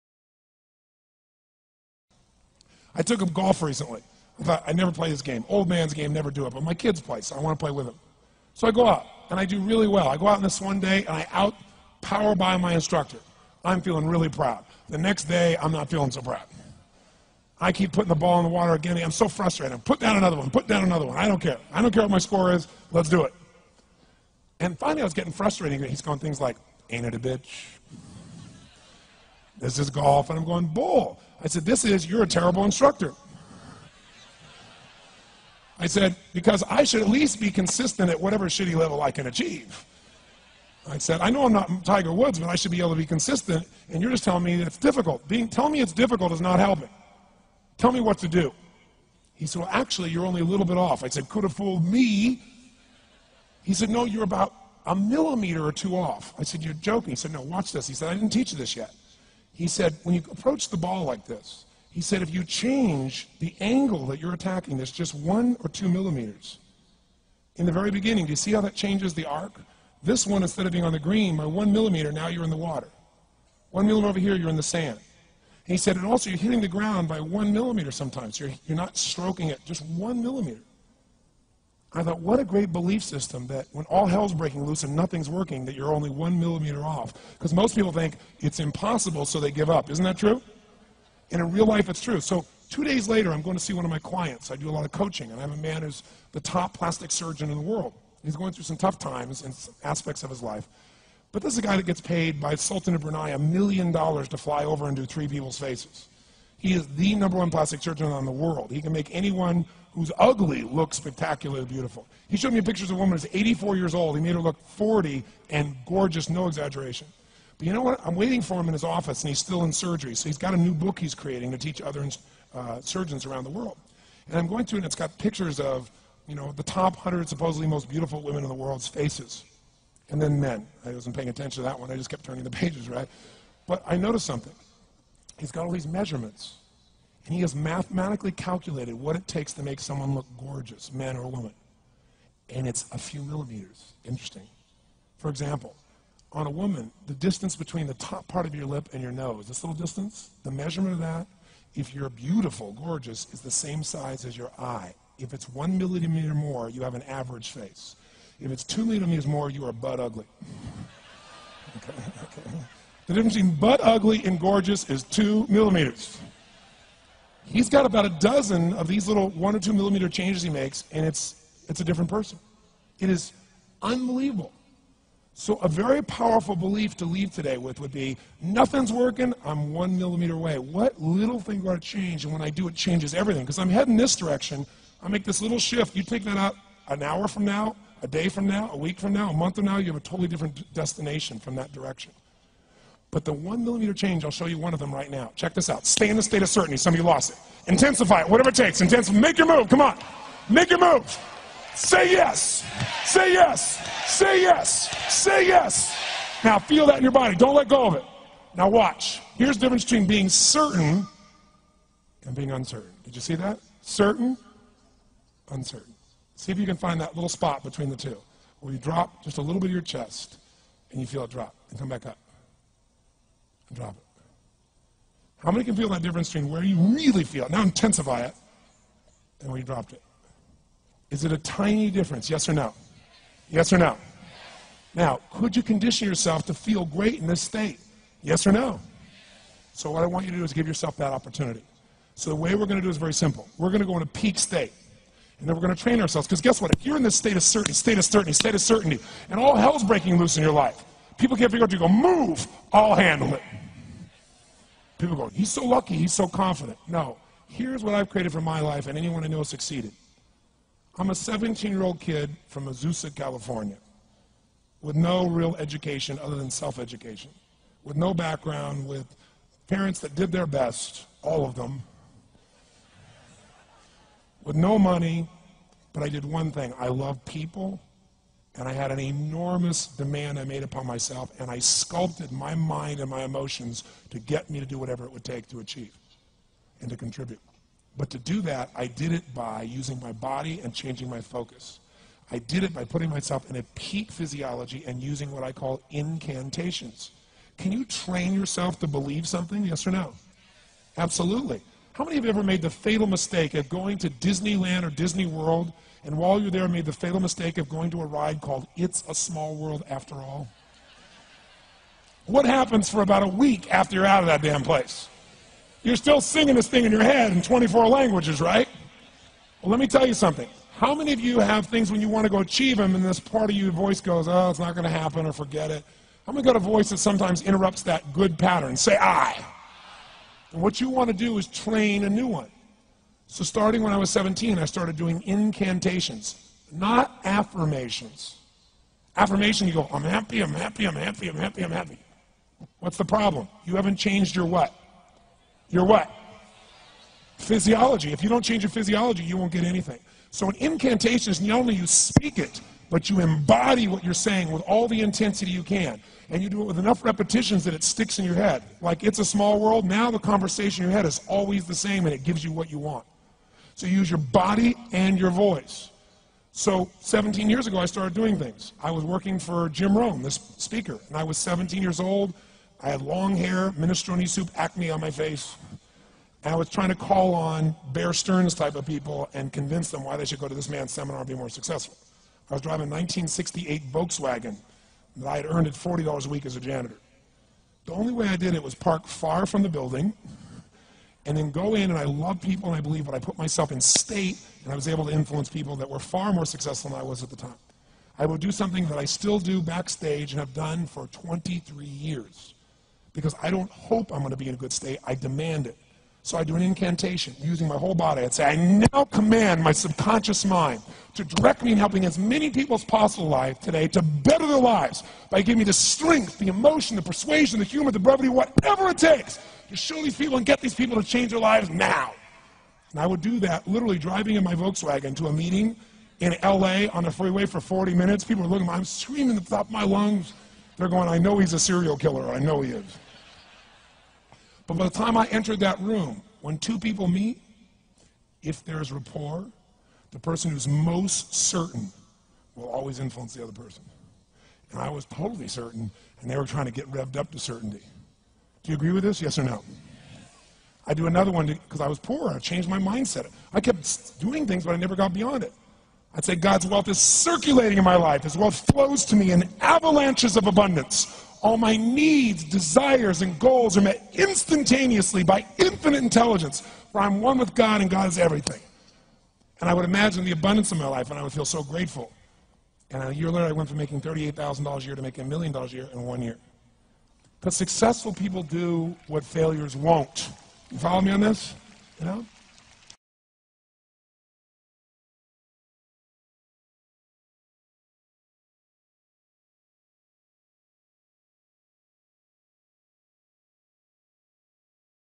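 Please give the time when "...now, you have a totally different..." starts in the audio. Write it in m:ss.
3:09.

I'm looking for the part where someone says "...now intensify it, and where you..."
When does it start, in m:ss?
3:47.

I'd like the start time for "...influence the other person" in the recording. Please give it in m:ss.
7:22.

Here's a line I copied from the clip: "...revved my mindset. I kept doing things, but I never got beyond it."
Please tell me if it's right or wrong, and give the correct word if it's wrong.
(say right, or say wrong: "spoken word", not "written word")
wrong: "changed", not "revved".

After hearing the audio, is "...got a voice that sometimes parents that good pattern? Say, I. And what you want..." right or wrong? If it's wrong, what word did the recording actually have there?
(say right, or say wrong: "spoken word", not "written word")
wrong: "interrupts", not "parents".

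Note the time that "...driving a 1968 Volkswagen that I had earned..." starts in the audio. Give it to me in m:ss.
6:22.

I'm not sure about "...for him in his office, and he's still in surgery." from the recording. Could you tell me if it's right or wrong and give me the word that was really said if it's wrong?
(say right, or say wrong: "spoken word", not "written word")
right.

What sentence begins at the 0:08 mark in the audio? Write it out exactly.
So I go out, and I do really well.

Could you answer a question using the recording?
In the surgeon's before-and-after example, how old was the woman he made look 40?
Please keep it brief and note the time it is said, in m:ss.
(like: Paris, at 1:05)
84, at 1:53.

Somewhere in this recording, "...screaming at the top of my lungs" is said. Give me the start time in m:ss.
7:08.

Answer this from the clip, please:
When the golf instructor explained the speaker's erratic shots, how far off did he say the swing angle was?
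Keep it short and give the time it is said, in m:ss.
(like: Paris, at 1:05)
1 or 2 millimeters, at 0:54.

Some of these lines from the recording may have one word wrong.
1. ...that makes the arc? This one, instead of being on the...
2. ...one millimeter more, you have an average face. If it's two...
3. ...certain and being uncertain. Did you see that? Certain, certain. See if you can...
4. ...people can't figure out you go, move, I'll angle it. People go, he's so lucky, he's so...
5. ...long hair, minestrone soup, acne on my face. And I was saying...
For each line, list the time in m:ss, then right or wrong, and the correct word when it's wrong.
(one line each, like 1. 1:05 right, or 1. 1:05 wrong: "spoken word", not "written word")
1. 1:08 wrong: "changes", not "makes"
2. 2:35 right
3. 3:30 wrong: "uncertain", not "certain"
4. 4:11 wrong: "handle", not "angle"
5. 6:13 wrong: "trying", not "saying".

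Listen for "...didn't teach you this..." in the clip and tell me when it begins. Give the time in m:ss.
0:58.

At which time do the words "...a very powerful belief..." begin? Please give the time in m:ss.
2:55.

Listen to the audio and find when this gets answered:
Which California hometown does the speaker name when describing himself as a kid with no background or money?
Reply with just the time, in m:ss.
4:22.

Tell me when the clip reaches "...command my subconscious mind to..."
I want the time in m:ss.
6:49.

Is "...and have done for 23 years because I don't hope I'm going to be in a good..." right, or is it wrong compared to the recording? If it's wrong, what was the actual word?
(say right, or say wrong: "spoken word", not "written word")
right.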